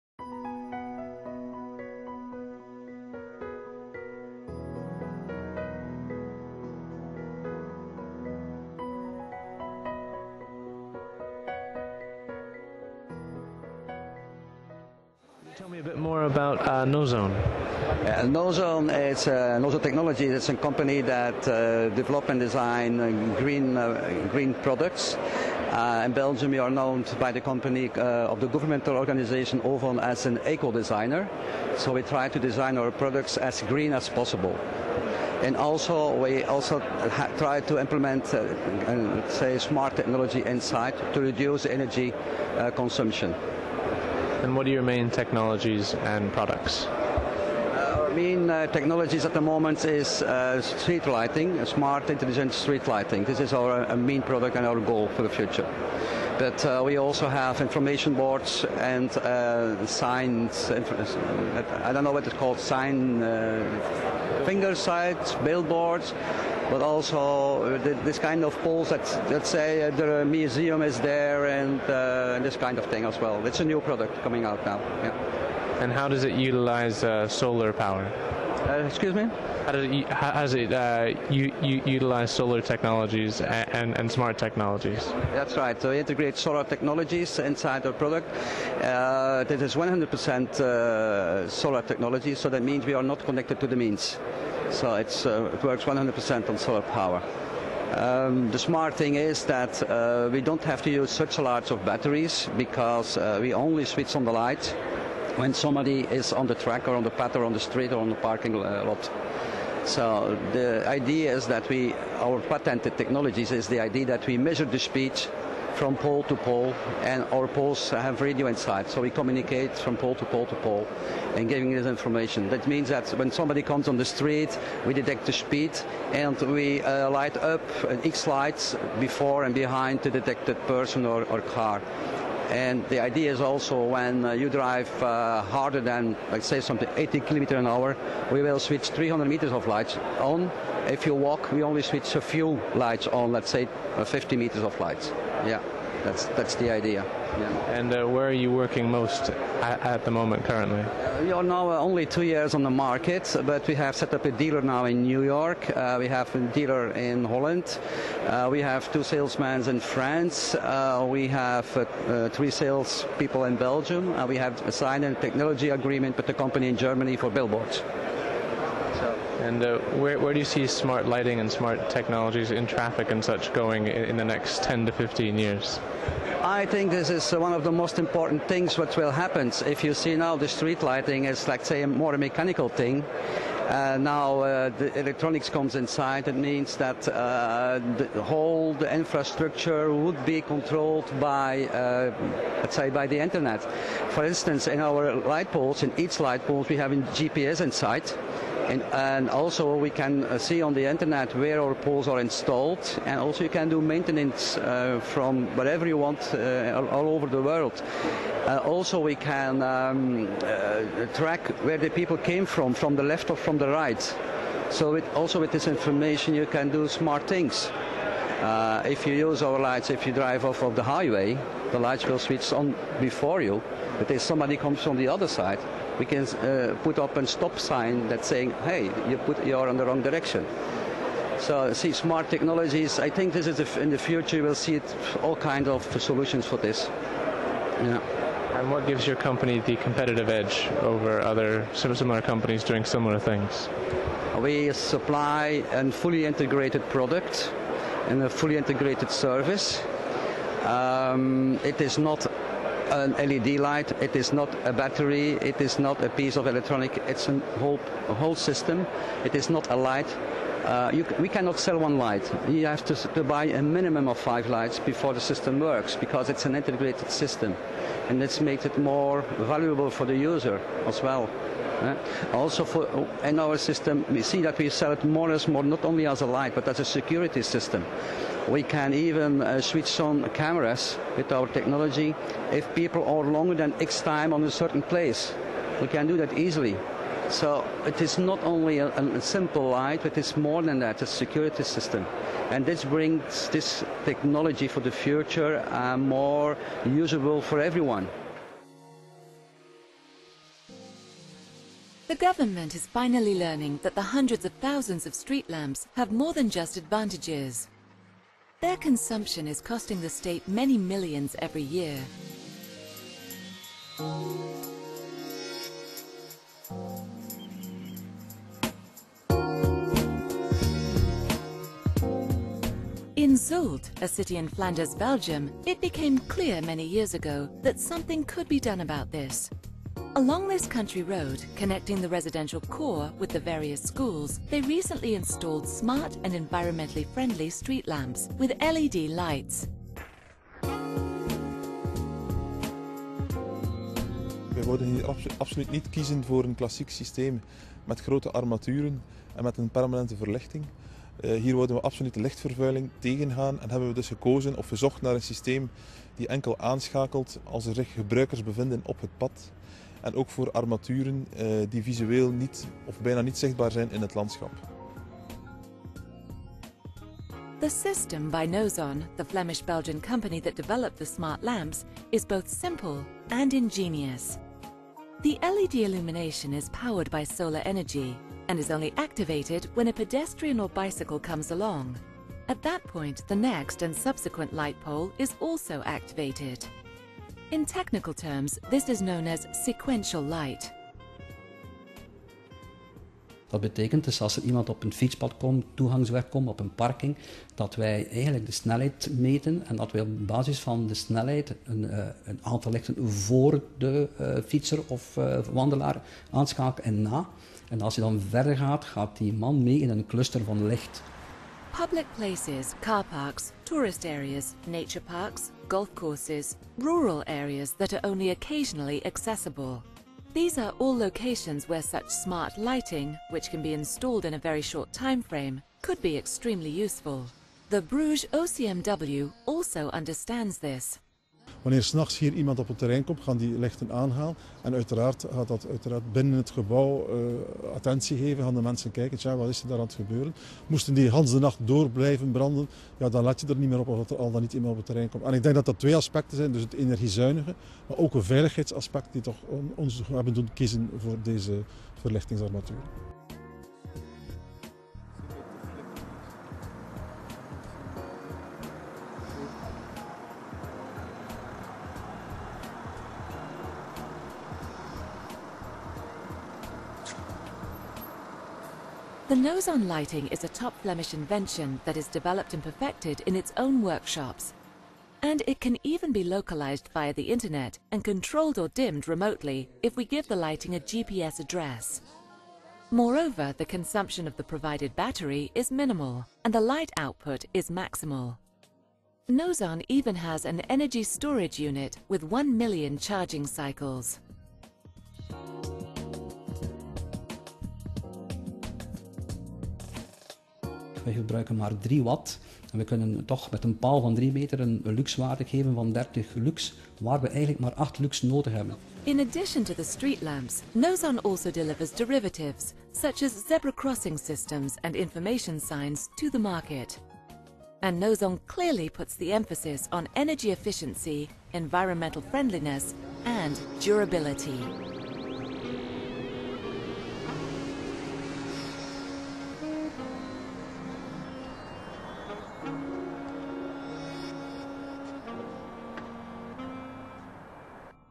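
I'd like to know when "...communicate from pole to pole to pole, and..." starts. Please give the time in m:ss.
1:59.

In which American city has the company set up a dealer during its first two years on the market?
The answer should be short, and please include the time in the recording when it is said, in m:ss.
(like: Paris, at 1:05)
New York, at 2:35.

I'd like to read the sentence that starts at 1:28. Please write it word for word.
Uh, that is 100% uh, solar technology, so that means we are not connected to the means.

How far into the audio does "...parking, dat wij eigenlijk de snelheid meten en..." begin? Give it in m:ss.
6:36.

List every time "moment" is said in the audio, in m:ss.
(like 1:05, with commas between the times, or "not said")
0:49, 2:30.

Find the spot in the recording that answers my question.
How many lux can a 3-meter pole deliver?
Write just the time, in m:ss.
8:25.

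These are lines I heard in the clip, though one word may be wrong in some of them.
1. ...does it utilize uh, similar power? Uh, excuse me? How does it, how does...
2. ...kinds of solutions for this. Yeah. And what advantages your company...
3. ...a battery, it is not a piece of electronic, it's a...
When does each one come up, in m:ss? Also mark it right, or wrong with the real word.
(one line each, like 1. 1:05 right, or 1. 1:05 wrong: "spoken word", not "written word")
1. 1:16 wrong: "solar", not "similar"
2. 3:55 wrong: "gives", not "advantages"
3. 4:14 right.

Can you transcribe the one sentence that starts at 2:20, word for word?
If you walk, we only switch a few lights on, let's say, uh, 50 meters of lights.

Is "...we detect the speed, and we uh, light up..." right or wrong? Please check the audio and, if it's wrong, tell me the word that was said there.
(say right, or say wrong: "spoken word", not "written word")
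right.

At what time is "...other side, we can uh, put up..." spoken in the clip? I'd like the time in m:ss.
3:45.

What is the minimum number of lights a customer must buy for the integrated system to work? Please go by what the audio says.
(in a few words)
5.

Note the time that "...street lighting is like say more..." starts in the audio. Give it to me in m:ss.
3:00.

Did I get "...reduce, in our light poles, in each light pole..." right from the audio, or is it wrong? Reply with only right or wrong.
wrong.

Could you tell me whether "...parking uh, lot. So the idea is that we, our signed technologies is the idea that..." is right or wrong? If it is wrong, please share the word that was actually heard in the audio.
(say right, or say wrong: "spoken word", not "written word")
wrong: "patented", not "signed".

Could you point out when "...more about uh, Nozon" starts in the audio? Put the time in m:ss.
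0:15.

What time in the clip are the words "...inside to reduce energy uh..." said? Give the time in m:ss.
0:40.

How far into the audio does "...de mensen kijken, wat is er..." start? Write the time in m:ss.
7:18.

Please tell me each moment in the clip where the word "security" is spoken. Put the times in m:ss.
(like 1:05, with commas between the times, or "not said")
4:36, 4:51.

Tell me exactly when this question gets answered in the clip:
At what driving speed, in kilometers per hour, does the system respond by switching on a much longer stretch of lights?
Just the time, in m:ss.
2:16.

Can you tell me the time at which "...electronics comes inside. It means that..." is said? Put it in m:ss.
3:04.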